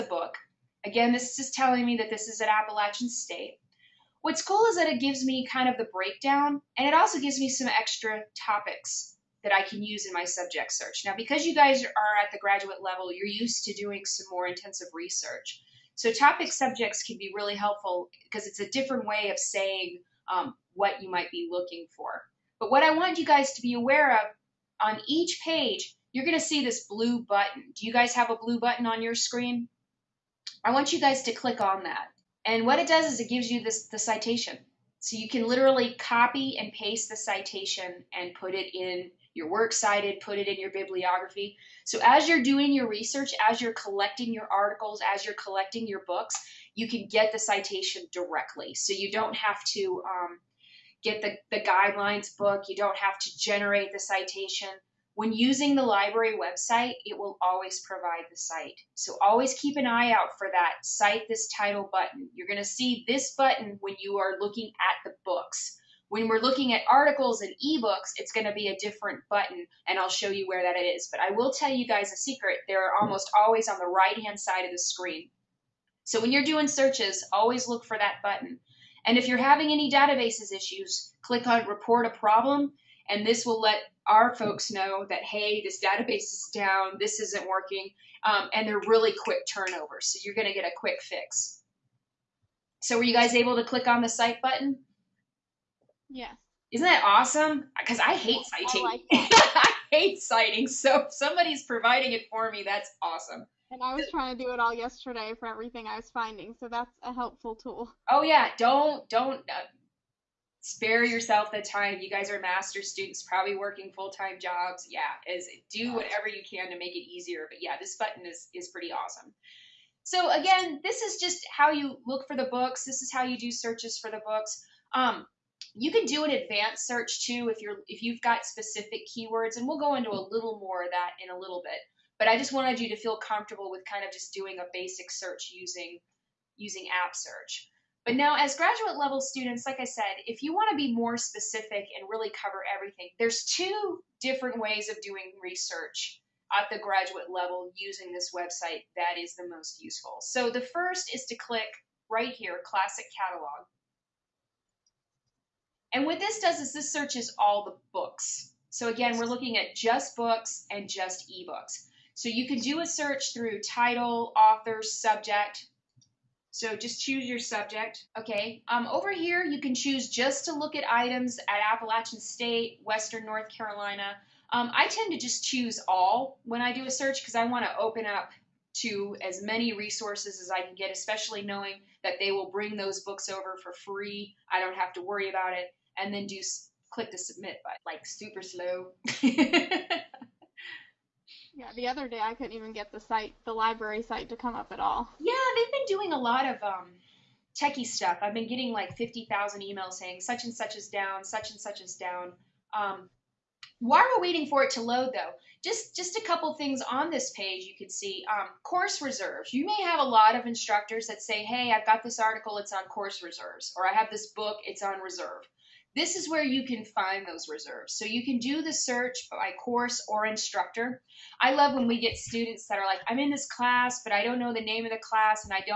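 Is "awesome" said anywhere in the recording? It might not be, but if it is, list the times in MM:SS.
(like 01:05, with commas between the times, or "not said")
01:37, 01:43, 01:58.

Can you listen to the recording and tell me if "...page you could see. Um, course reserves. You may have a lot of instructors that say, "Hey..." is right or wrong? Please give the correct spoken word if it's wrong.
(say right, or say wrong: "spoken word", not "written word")
right.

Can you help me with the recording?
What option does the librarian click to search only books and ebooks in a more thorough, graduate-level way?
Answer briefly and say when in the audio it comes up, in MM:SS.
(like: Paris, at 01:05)
Classic Catalog, at 02:32.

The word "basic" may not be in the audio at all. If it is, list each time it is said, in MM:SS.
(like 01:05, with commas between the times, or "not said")
02:14.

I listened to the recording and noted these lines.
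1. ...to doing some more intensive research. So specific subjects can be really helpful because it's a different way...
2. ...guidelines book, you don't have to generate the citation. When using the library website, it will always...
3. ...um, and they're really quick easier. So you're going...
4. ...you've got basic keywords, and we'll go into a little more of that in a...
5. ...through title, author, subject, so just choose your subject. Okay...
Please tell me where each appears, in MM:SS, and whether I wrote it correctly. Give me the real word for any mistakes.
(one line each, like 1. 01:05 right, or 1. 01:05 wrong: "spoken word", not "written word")
1. 00:13 wrong: "topic", not "specific"
2. 00:51 right
3. 01:28 wrong: "turnover", not "easier"
4. 02:08 wrong: "specific", not "basic"
5. 02:43 right.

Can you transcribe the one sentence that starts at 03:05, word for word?
And then do click the submit button, like super slow.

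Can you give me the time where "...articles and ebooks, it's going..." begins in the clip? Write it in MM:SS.
01:06.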